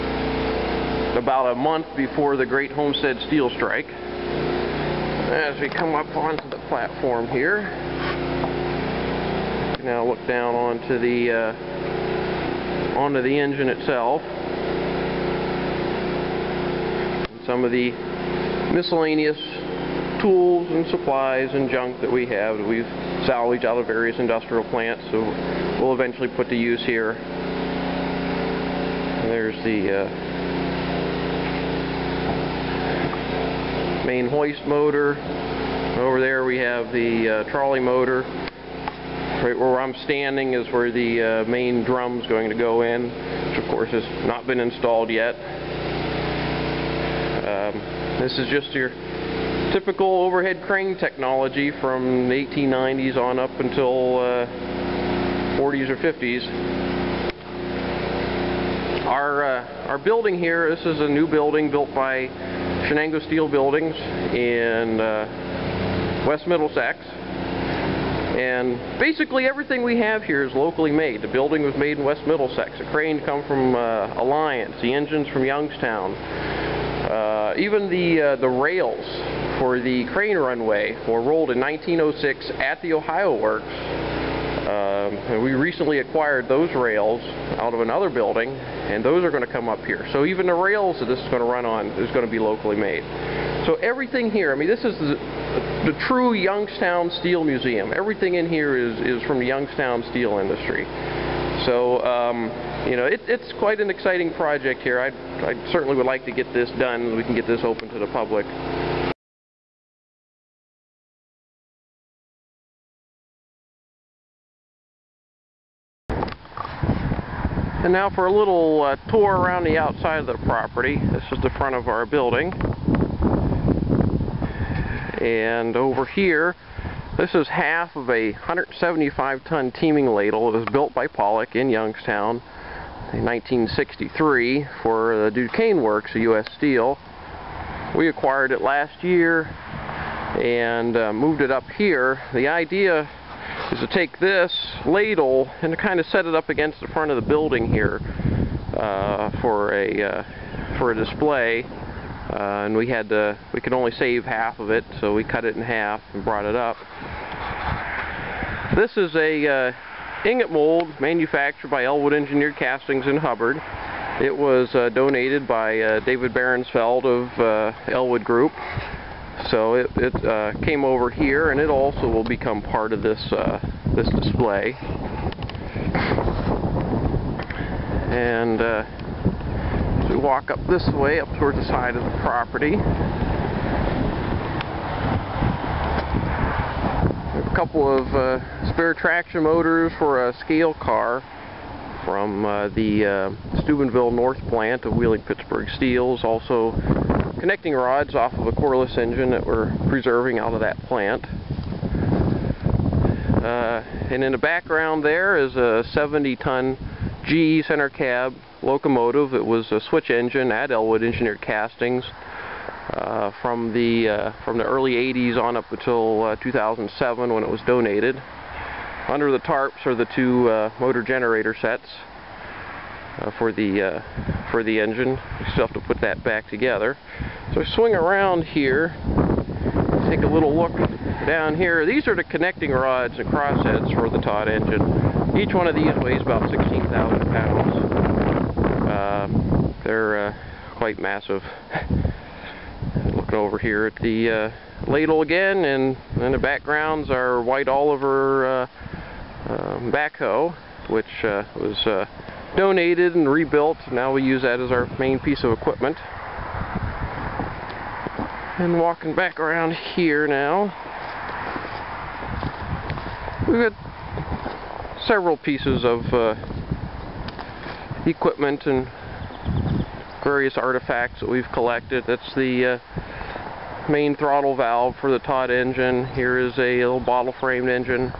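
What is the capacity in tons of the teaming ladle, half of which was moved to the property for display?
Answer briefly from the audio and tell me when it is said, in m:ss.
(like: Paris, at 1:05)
175, at 2:08.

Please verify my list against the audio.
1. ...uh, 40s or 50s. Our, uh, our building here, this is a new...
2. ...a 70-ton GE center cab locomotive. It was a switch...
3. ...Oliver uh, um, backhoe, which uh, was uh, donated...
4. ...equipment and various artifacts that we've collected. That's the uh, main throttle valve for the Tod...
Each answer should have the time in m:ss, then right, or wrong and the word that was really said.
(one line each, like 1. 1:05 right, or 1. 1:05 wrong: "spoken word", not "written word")
1. 0:54 right
2. 3:25 right
3. 4:07 right
4. 4:28 right.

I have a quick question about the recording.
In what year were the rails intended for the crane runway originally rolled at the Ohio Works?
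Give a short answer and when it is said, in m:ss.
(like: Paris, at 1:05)
1906, at 1:21.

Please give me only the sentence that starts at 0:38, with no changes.
Right where I'm standing is where the uh, main is going to go in, which of course has not been installed yet.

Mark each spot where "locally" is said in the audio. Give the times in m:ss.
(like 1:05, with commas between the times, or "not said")
1:10, 1:32.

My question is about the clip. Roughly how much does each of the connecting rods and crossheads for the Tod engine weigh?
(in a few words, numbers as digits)
16,000 pounds.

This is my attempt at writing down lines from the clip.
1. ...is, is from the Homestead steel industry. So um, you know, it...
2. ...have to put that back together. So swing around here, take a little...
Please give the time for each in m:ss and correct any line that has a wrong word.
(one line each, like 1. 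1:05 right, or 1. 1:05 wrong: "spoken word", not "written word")
1. 1:38 wrong: "Youngstown", not "Homestead"
2. 3:45 right.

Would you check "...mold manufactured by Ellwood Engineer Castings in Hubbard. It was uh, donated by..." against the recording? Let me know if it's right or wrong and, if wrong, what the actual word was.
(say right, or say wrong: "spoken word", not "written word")
right.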